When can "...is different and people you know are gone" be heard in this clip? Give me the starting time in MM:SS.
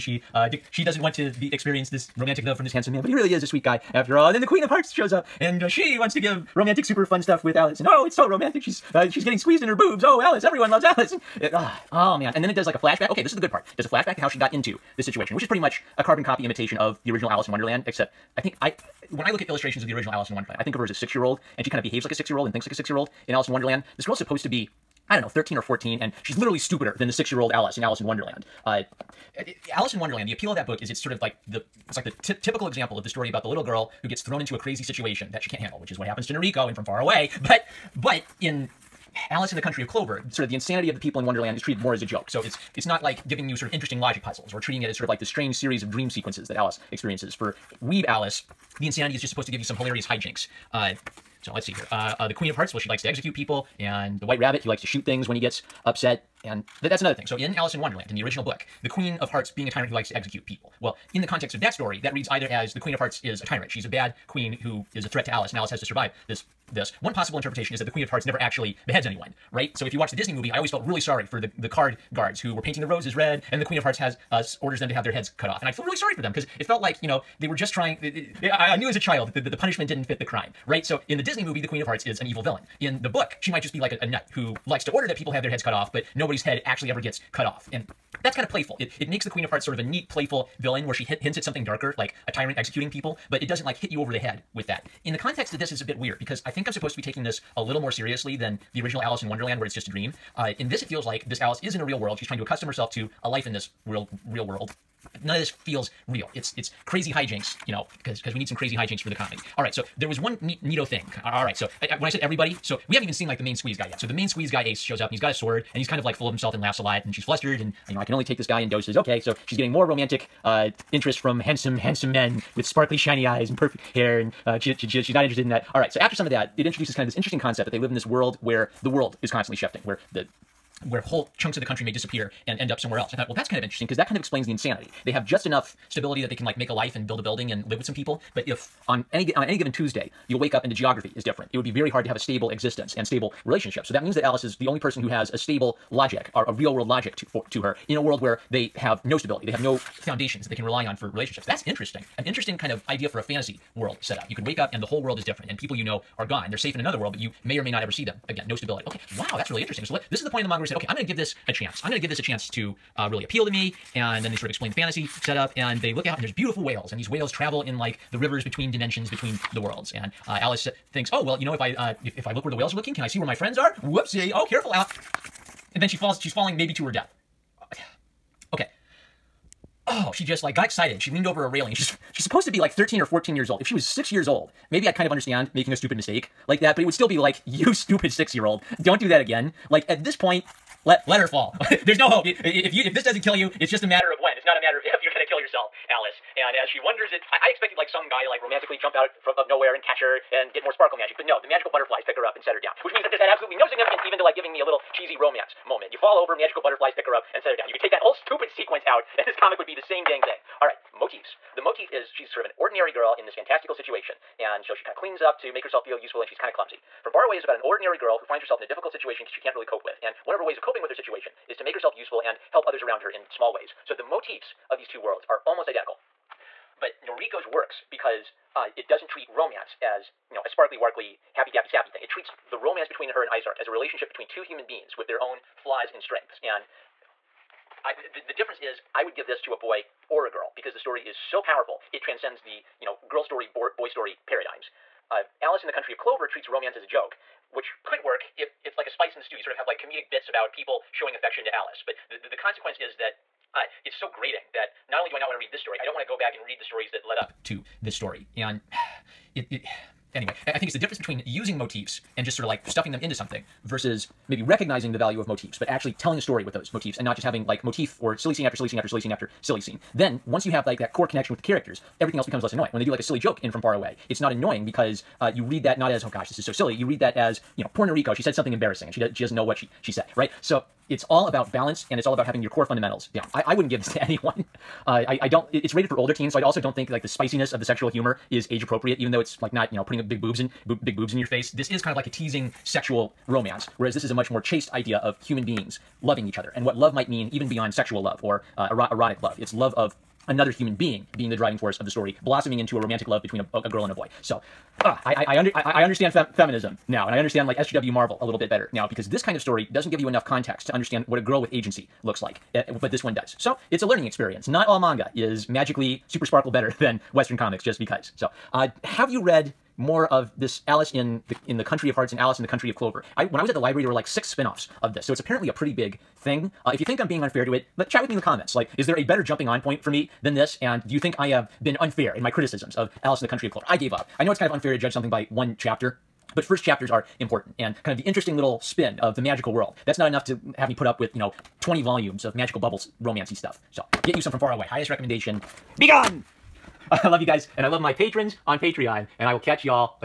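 02:35.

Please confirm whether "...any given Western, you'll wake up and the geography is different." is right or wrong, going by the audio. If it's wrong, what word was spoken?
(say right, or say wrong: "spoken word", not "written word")
wrong: "Tuesday", not "Western".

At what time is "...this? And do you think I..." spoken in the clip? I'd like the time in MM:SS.
05:30.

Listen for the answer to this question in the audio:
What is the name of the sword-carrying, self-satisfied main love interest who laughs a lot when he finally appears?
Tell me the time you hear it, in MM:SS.
01:54.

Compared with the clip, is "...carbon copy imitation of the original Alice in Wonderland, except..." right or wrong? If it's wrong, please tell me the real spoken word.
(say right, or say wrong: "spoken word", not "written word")
right.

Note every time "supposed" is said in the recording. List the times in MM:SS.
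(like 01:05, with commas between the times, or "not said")
00:24, 00:49, 01:36, 03:02.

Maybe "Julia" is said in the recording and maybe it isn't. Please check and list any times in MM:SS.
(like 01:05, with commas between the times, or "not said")
not said.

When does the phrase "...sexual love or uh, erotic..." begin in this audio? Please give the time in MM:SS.
04:57.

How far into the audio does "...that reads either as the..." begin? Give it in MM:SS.
01:02.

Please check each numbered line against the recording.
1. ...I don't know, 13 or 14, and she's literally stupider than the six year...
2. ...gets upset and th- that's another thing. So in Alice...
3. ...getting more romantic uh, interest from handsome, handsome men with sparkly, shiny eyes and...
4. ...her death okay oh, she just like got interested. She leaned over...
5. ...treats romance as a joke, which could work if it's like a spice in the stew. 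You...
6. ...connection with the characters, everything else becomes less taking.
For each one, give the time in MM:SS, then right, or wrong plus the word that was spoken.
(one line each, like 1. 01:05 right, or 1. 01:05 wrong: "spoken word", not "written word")
1. 00:25 right
2. 00:55 right
3. 01:59 right
4. 02:56 wrong: "excited", not "interested"
5. 04:06 right
6. 04:31 wrong: "annoying", not "taking".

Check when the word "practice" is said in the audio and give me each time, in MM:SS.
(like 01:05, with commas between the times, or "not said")
not said.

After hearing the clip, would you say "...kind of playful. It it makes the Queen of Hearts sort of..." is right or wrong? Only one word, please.
right.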